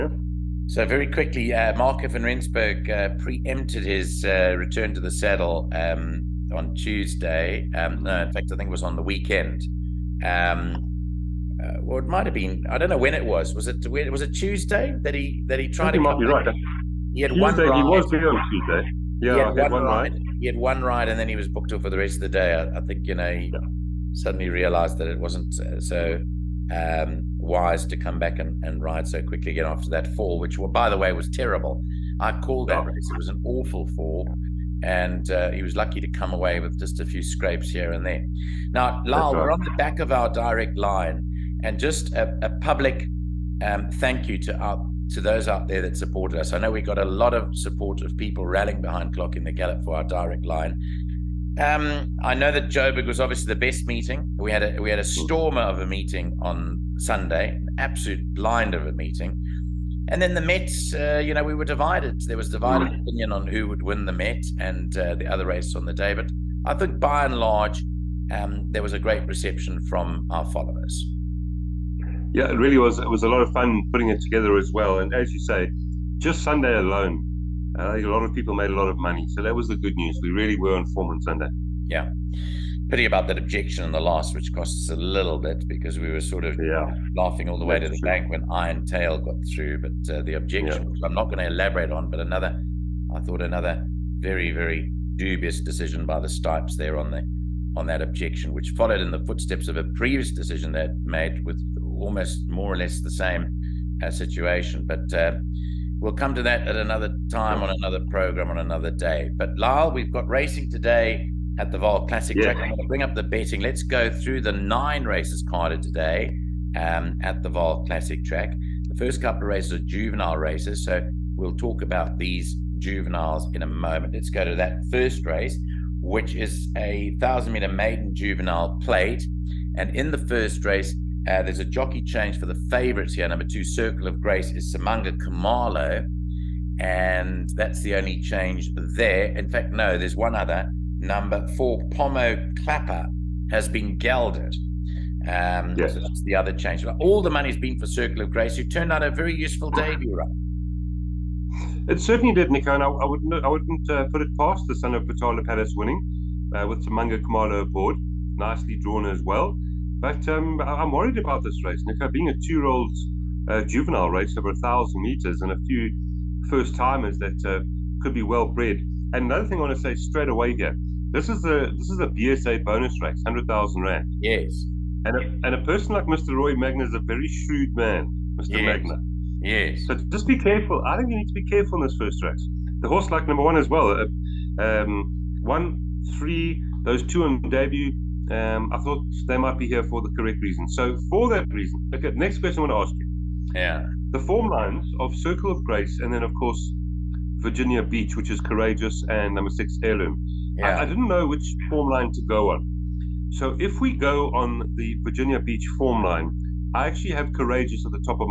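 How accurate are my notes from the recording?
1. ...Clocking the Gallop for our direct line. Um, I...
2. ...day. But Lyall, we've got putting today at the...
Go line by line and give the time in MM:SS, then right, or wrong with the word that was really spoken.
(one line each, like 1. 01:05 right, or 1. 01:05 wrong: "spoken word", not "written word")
1. 00:49 right
2. 01:48 wrong: "racing", not "putting".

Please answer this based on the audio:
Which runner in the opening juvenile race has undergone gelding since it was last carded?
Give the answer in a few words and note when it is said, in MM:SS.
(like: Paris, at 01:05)
Pomo Clapper, at 02:21.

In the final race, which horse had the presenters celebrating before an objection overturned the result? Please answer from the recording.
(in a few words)
Iron Tail.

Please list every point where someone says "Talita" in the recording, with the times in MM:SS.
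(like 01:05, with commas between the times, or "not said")
not said.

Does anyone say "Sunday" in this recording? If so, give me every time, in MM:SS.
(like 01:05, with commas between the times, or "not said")
00:56, 01:16, 01:21.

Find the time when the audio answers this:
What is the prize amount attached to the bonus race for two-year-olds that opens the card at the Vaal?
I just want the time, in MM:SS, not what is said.
02:53.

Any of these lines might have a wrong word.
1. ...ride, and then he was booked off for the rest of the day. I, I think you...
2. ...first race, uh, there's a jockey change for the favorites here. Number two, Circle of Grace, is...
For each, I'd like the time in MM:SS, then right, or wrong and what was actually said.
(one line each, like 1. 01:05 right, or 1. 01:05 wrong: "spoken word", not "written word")
1. 00:20 right
2. 02:10 right.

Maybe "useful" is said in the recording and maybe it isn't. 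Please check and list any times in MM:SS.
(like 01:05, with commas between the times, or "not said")
02:29.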